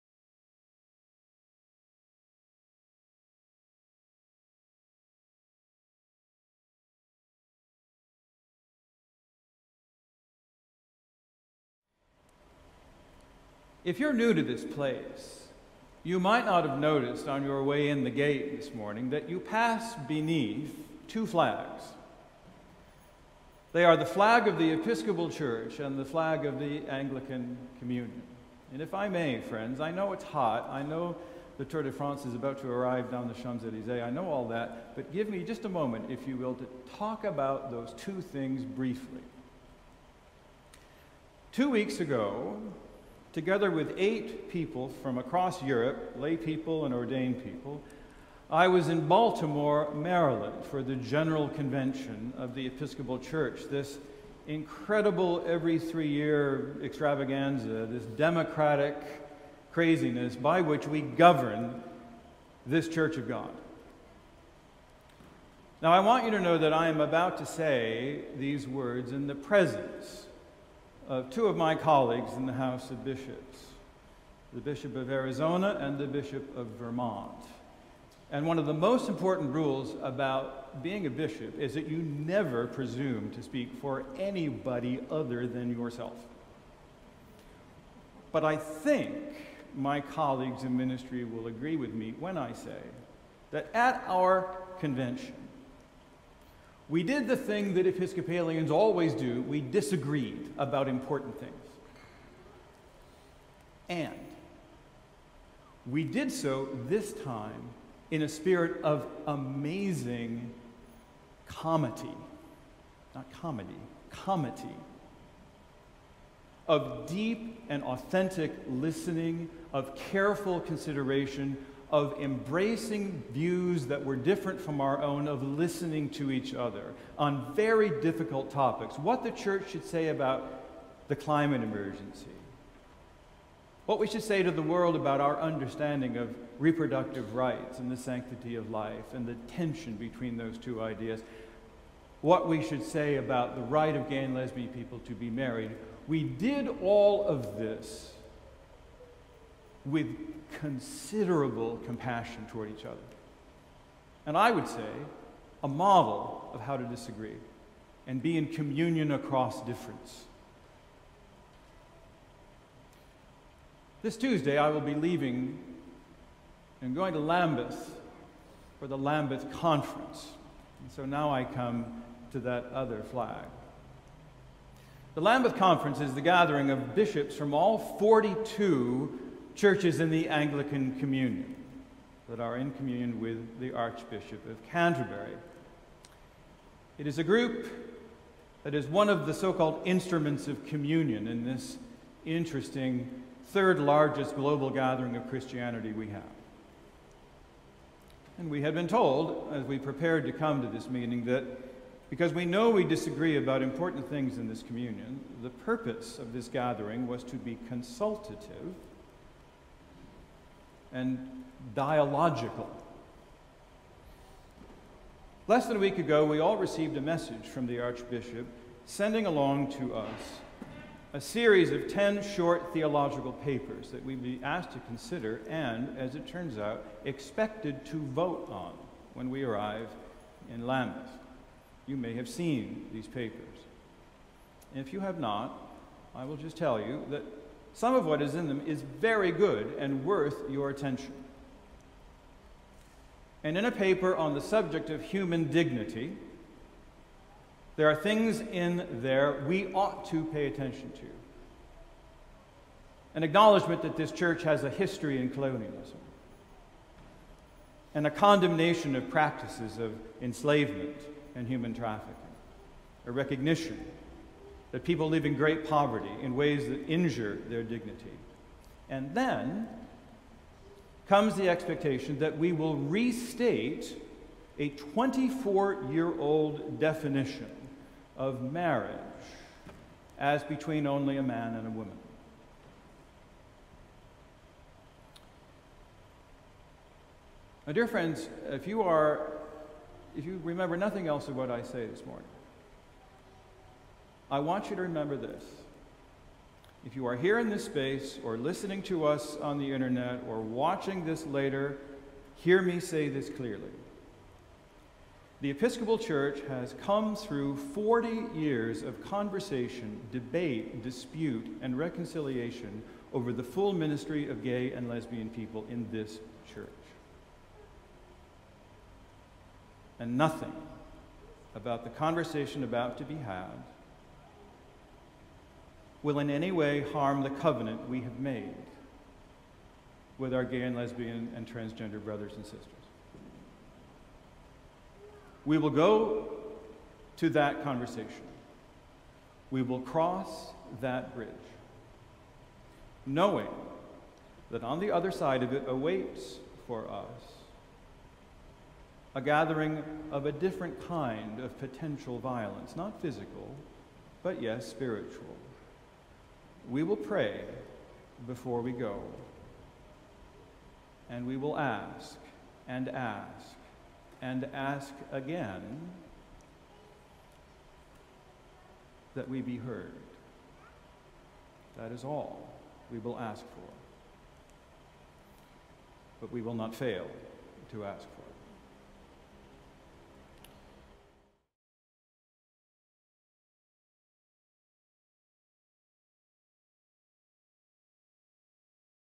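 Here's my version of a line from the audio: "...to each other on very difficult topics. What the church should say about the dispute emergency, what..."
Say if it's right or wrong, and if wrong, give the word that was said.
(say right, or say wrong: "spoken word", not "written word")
wrong: "climate", not "dispute".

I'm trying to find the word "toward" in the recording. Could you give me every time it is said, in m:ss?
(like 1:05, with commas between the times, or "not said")
2:32.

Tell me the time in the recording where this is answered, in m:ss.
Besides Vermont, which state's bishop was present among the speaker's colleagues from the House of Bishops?
1:15.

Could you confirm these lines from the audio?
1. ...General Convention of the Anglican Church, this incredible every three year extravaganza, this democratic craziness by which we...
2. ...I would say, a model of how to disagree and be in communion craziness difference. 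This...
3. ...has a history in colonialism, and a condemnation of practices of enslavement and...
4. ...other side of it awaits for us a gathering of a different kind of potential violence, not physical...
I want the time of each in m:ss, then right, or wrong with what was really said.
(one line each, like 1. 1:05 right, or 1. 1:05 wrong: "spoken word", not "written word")
1. 0:50 wrong: "Episcopal", not "Anglican"
2. 2:34 wrong: "across", not "craziness"
3. 4:14 right
4. 5:44 right.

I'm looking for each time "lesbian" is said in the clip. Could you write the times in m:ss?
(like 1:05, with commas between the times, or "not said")
2:24, 5:14, 5:30.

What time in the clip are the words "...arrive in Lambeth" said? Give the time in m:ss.
3:49.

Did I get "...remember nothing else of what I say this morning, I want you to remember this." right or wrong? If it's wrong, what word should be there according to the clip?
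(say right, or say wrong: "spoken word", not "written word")
right.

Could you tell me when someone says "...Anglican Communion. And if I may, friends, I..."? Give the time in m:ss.
0:26.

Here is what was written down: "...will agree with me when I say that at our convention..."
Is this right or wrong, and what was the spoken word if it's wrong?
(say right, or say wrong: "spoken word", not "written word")
right.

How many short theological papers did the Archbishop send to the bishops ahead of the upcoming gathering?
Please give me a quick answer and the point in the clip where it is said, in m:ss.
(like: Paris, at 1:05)
10, at 3:41.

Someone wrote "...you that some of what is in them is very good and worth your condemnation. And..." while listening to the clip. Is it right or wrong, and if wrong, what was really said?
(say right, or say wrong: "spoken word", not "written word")
wrong: "attention", not "condemnation".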